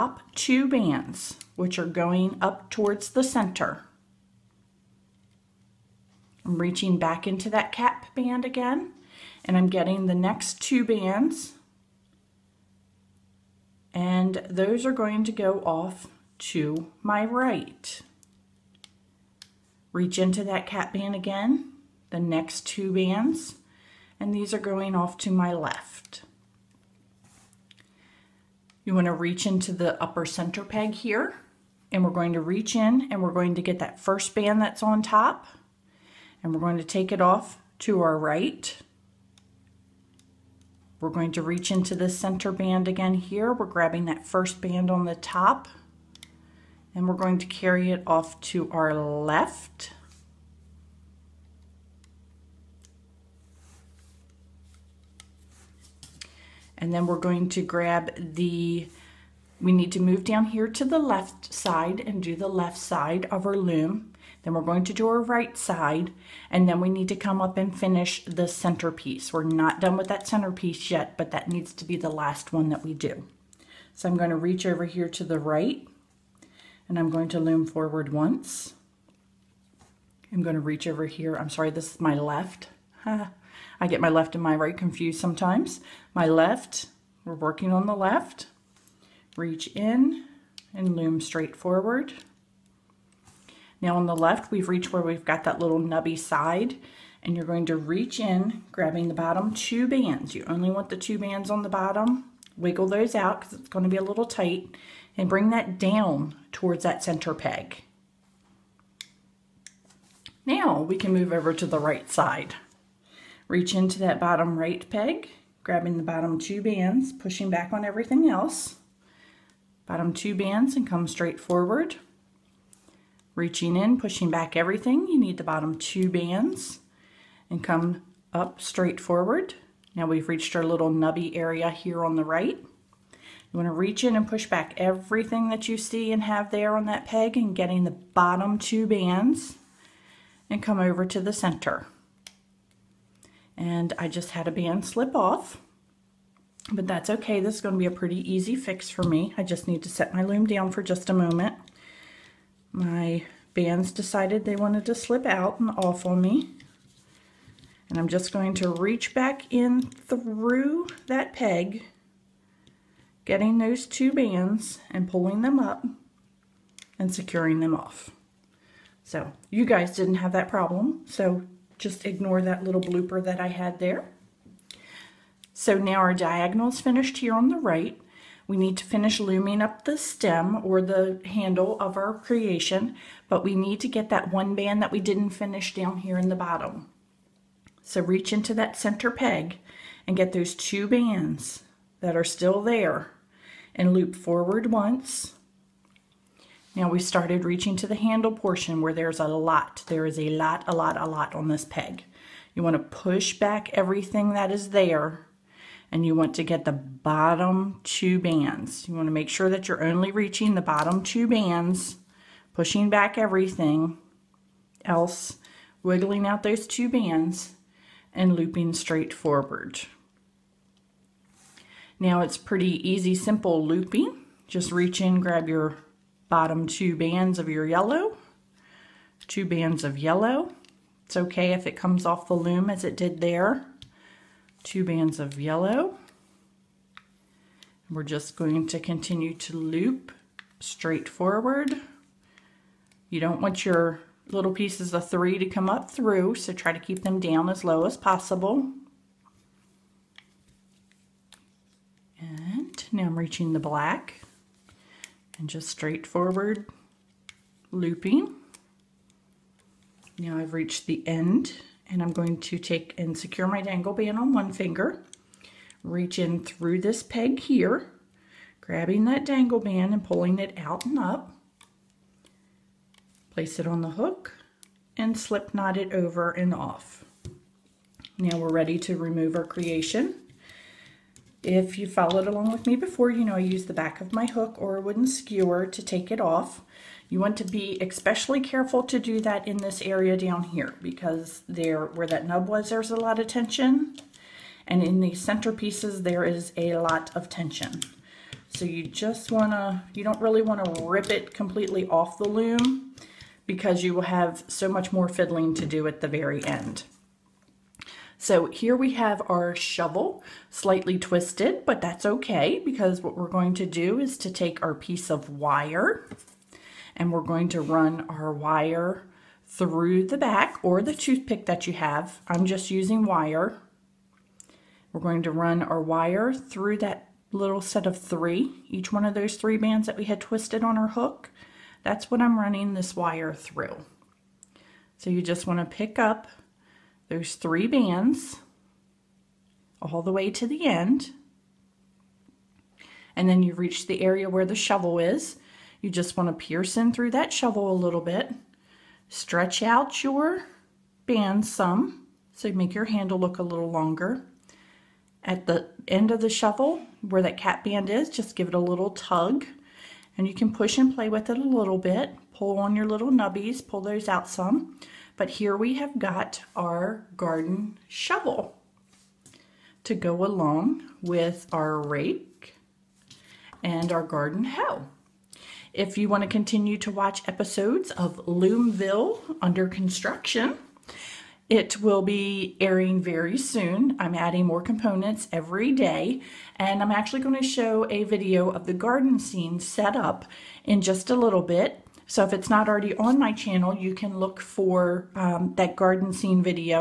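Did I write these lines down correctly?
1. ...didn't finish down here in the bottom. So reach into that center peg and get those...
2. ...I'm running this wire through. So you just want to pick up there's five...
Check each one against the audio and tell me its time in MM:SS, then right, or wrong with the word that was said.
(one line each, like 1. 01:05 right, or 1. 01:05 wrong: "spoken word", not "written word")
1. 03:05 right
2. 05:32 wrong: "three", not "five".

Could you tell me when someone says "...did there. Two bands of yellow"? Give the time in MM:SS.
03:52.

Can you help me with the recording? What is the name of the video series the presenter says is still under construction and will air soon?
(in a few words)
Loomville.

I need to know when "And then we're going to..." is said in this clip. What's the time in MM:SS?
00:56.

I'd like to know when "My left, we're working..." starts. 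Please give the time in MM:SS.
01:26.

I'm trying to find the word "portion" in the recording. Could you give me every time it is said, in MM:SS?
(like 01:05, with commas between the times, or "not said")
03:18.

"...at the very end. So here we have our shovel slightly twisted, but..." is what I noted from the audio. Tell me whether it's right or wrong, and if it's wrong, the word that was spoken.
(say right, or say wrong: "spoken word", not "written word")
right.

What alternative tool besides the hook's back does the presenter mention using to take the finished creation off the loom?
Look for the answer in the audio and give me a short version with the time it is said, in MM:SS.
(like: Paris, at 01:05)
A wooden skewer, at 04:44.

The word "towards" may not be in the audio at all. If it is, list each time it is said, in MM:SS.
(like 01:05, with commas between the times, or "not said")
00:02, 01:46.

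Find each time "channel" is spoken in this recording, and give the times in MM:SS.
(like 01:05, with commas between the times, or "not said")
06:33.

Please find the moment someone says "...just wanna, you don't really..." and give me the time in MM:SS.
04:58.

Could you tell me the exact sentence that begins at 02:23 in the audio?
And I just had a band slip off, but that's okay.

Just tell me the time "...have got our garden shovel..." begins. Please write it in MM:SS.
06:05.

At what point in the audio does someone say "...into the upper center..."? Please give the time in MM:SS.
00:29.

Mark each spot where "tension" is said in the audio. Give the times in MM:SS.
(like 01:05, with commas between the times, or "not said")
04:53, 04:57.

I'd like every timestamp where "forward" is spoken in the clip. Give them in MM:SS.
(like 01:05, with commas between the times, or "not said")
01:17, 01:31, 02:01, 02:08, 03:14, 03:39, 04:01, 04:16.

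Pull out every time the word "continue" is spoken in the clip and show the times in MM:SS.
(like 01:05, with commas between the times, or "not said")
03:58, 06:16.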